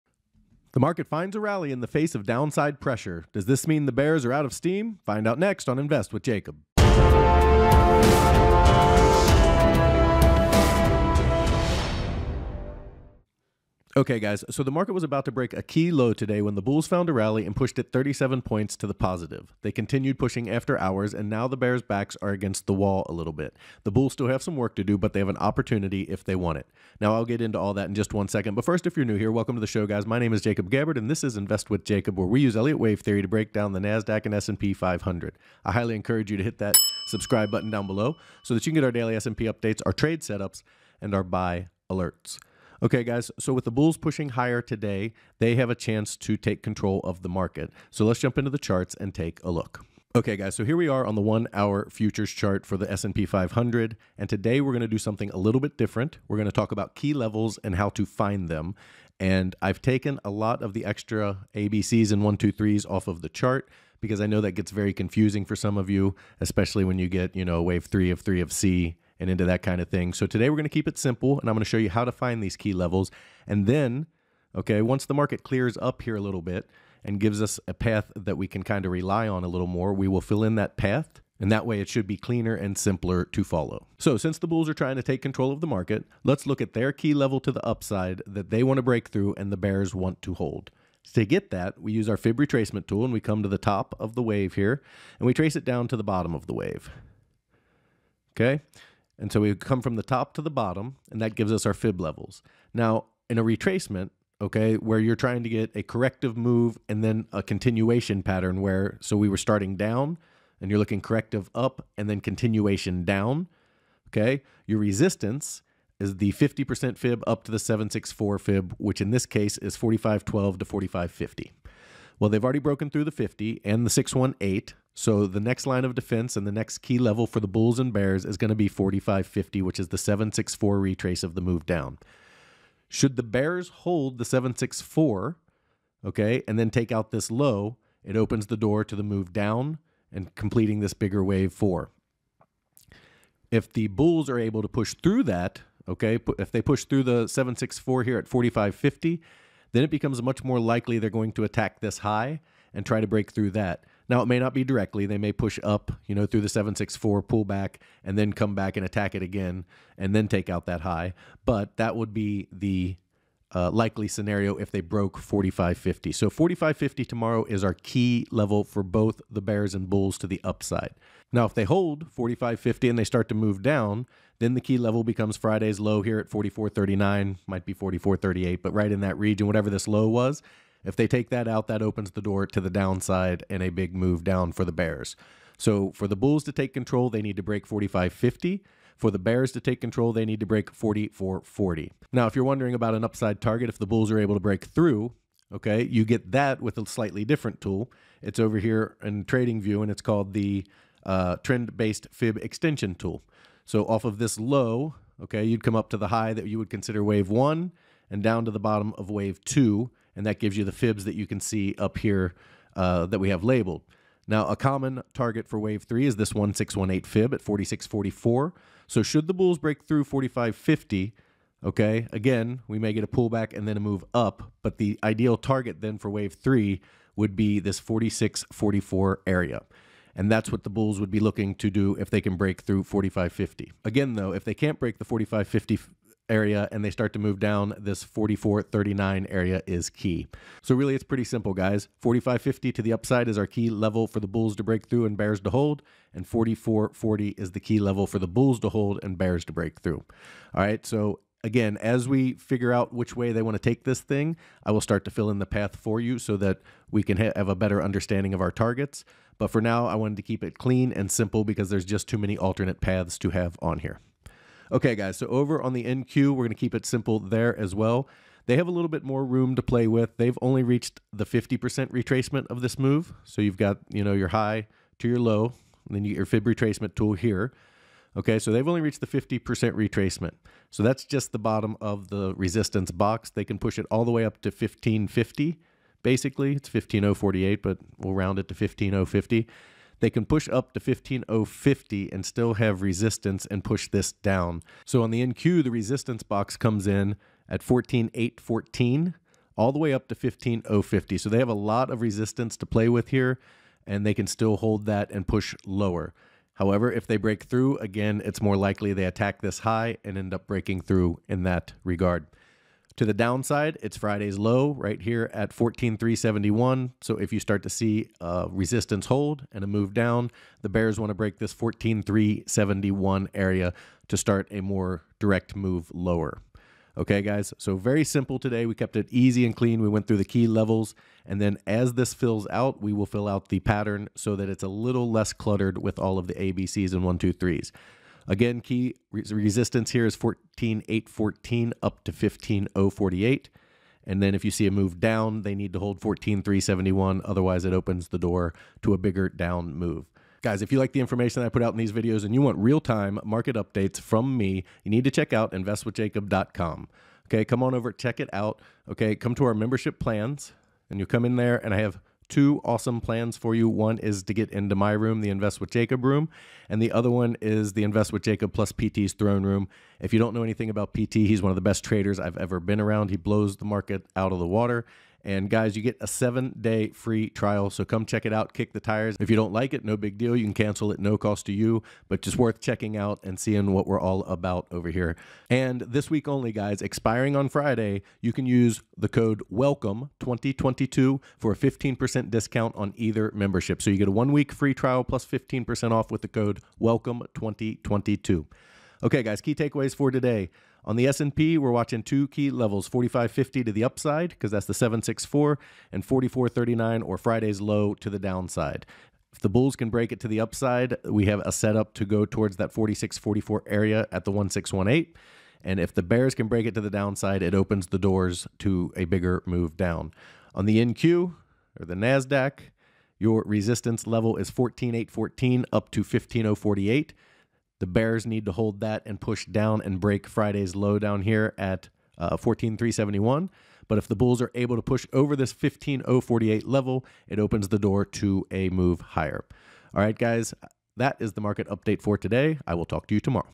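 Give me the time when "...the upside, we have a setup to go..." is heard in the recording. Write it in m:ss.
6:50.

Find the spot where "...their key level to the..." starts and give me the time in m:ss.
1:26.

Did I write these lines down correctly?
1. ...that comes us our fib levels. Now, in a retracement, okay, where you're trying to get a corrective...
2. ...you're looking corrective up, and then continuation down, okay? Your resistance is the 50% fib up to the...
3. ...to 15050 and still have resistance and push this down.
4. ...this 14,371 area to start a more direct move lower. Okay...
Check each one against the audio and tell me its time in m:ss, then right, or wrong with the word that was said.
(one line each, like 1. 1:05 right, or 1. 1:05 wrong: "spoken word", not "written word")
1. 1:41 wrong: "gives", not "comes"
2. 1:50 right
3. 4:50 right
4. 5:21 right.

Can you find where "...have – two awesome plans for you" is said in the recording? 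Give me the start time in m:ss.
6:01.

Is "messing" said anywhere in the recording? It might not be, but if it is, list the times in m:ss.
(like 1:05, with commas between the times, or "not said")
not said.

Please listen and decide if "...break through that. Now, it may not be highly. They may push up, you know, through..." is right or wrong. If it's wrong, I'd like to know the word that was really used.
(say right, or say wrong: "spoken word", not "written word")
wrong: "directly", not "highly".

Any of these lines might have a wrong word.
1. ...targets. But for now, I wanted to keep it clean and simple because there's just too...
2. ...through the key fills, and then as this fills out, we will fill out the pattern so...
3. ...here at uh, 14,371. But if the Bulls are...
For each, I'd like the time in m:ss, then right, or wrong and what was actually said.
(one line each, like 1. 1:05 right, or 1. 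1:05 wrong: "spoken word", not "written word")
1. 4:18 right
2. 5:30 wrong: "levels", not "fills"
3. 7:11 right.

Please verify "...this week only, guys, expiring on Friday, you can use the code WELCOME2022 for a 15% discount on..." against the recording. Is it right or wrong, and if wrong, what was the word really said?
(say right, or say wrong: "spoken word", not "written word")
right.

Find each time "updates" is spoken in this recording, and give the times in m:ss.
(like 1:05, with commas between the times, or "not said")
0:39, 5:53, 7:21.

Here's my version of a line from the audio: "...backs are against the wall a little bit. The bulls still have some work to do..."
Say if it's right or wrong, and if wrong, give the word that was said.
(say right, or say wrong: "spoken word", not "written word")
right.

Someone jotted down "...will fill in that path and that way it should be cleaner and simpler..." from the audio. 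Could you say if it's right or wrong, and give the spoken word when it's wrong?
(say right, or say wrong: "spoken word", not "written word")
right.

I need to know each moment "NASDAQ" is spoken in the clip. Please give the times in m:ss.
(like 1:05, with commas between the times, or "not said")
0:33, 7:01.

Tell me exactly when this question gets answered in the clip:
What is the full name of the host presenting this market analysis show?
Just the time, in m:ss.
0:30.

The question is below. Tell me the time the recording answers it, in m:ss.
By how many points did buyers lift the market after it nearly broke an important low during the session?
0:17.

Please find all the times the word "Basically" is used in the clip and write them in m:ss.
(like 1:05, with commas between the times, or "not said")
4:46.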